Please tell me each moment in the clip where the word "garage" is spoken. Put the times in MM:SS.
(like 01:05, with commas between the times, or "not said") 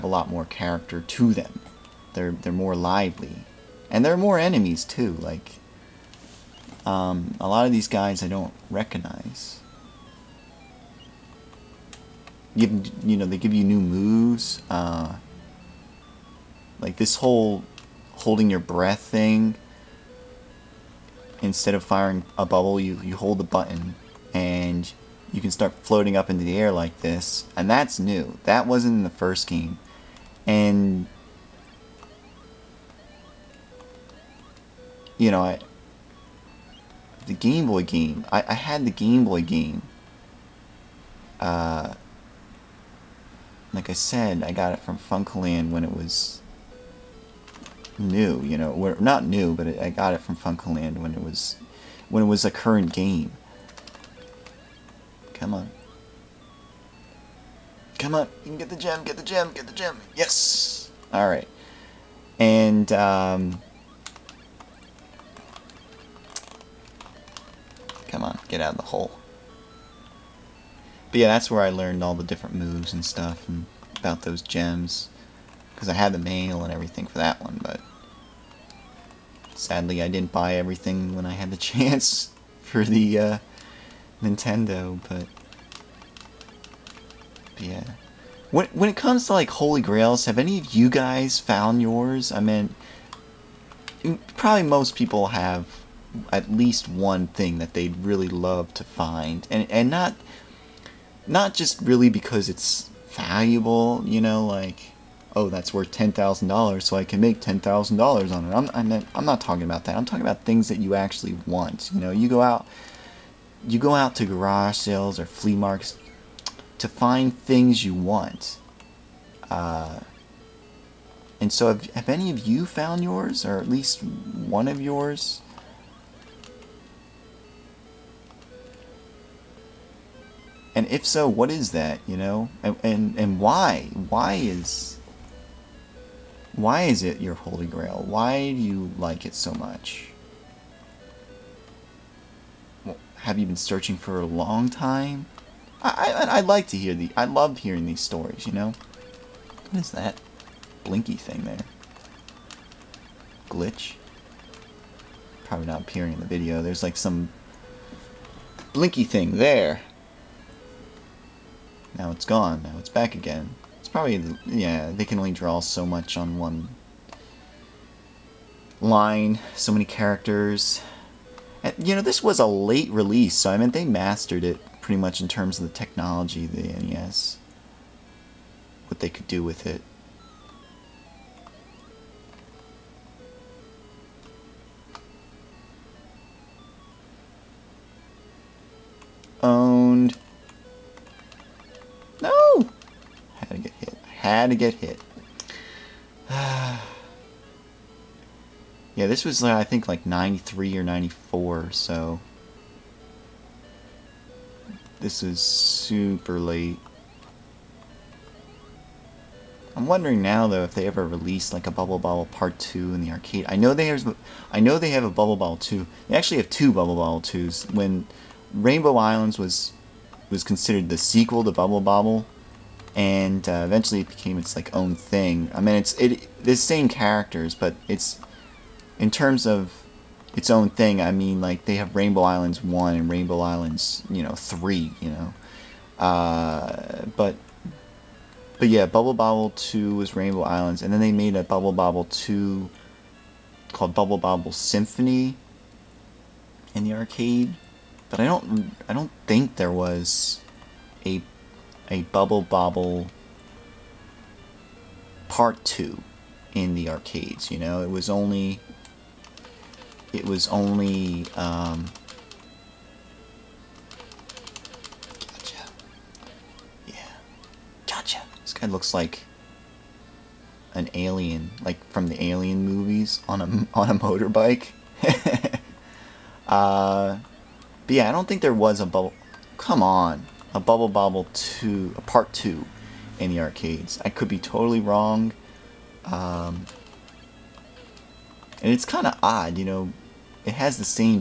01:54.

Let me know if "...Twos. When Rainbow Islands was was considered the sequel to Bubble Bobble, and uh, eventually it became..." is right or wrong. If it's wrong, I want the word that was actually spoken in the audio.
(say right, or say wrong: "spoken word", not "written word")
right.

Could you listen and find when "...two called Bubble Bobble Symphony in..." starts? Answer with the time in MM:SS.
04:02.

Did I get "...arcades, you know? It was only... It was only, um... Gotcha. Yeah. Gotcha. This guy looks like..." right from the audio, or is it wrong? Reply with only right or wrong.
right.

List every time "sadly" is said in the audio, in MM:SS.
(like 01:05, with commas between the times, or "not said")
01:19.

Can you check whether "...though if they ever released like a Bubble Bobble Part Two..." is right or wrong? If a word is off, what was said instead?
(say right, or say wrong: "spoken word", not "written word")
right.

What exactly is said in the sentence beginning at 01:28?
When, when it comes to like Holy Grails, have any of you guys found yours?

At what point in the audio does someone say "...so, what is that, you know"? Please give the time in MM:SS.
02:11.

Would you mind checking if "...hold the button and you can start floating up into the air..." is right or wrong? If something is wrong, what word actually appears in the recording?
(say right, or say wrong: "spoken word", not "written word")
right.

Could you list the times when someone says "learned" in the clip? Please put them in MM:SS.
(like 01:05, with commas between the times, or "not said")
01:11.